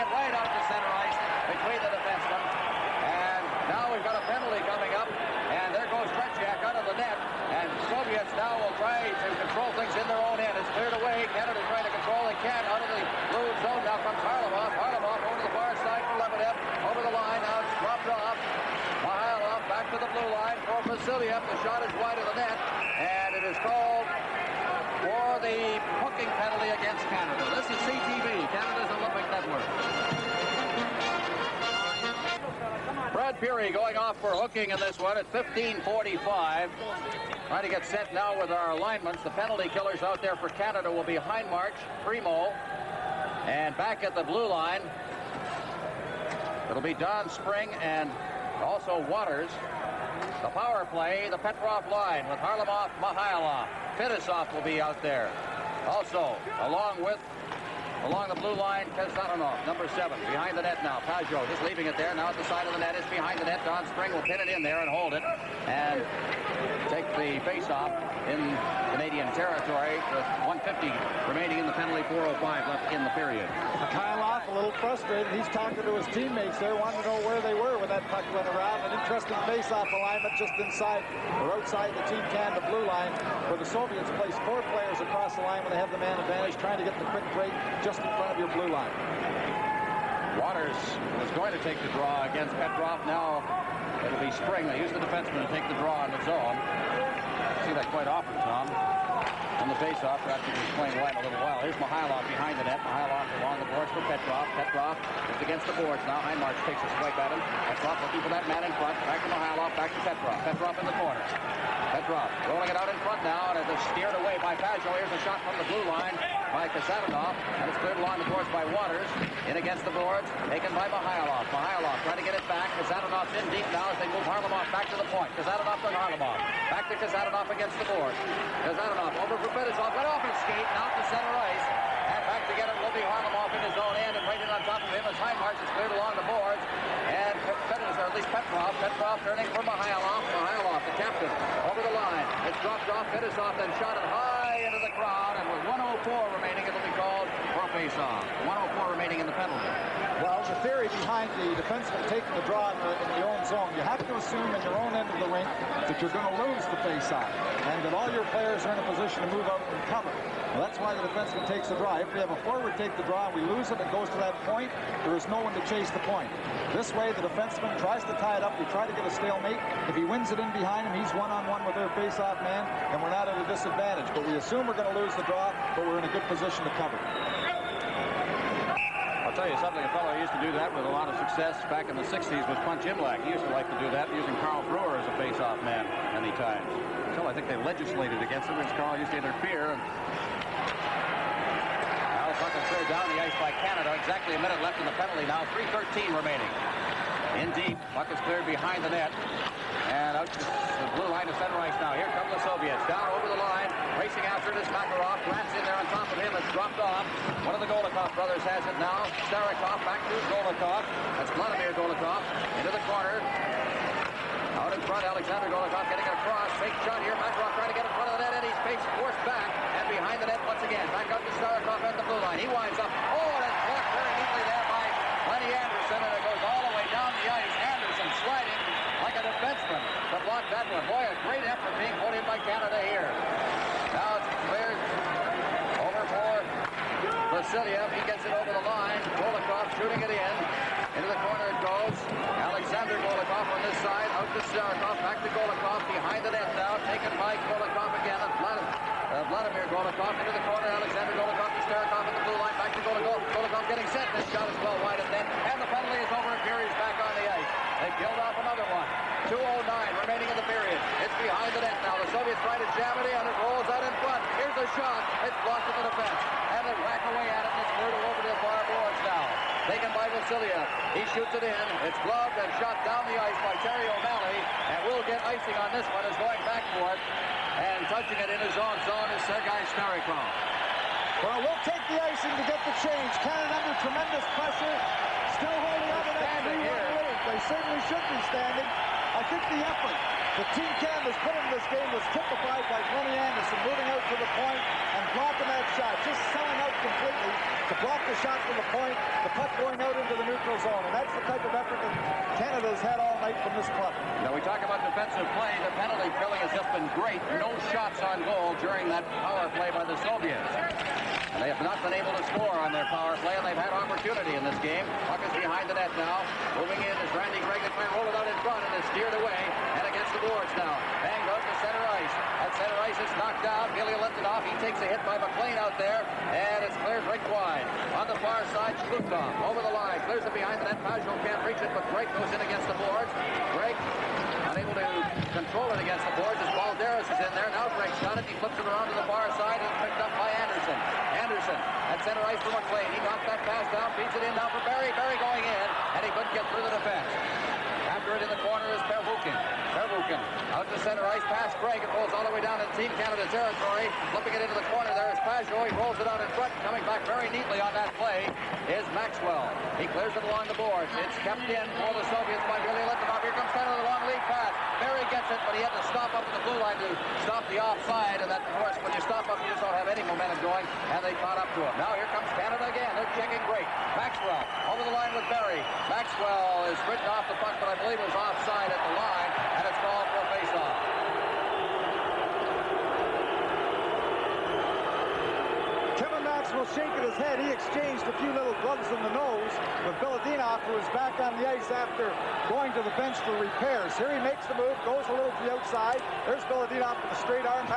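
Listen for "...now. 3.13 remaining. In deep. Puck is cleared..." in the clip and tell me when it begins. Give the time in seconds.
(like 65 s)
195 s.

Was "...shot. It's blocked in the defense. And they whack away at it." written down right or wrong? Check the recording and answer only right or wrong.
right.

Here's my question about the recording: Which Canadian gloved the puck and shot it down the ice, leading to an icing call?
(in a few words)
Terry O'Malley.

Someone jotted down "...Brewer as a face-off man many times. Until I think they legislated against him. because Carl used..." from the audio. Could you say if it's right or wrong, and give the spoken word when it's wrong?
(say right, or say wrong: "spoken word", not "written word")
right.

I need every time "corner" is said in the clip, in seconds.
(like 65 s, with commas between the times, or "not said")
111 s, 212 s, 241 s, 250 s, 354 s.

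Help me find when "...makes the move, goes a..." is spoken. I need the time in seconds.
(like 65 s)
394 s.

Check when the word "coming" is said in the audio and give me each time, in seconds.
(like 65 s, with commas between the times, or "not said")
4 s, 356 s.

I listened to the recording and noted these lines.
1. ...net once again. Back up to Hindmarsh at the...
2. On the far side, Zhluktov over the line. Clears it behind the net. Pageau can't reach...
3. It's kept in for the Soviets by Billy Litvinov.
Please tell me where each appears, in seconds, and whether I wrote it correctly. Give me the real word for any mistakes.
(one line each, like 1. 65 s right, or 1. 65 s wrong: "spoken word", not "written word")
1. 220 s wrong: "Starikov", not "Hindmarsh"
2. 327 s right
3. 361 s right.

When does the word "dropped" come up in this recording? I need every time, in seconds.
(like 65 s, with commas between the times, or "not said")
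17 s, 142 s, 206 s.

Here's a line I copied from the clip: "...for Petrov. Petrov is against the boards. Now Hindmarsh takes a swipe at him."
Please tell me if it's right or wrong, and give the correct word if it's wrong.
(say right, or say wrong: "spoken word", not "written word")
right.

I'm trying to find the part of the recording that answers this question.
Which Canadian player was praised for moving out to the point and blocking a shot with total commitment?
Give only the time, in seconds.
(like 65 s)
292 s.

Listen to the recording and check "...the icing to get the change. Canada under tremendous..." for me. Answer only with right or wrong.
right.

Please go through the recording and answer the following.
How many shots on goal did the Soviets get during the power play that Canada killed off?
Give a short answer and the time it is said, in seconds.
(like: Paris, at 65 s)
0, at 307 s.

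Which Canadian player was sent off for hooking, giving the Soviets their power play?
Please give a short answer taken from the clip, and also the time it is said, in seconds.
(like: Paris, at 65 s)
Brad Pirie, at 33 s.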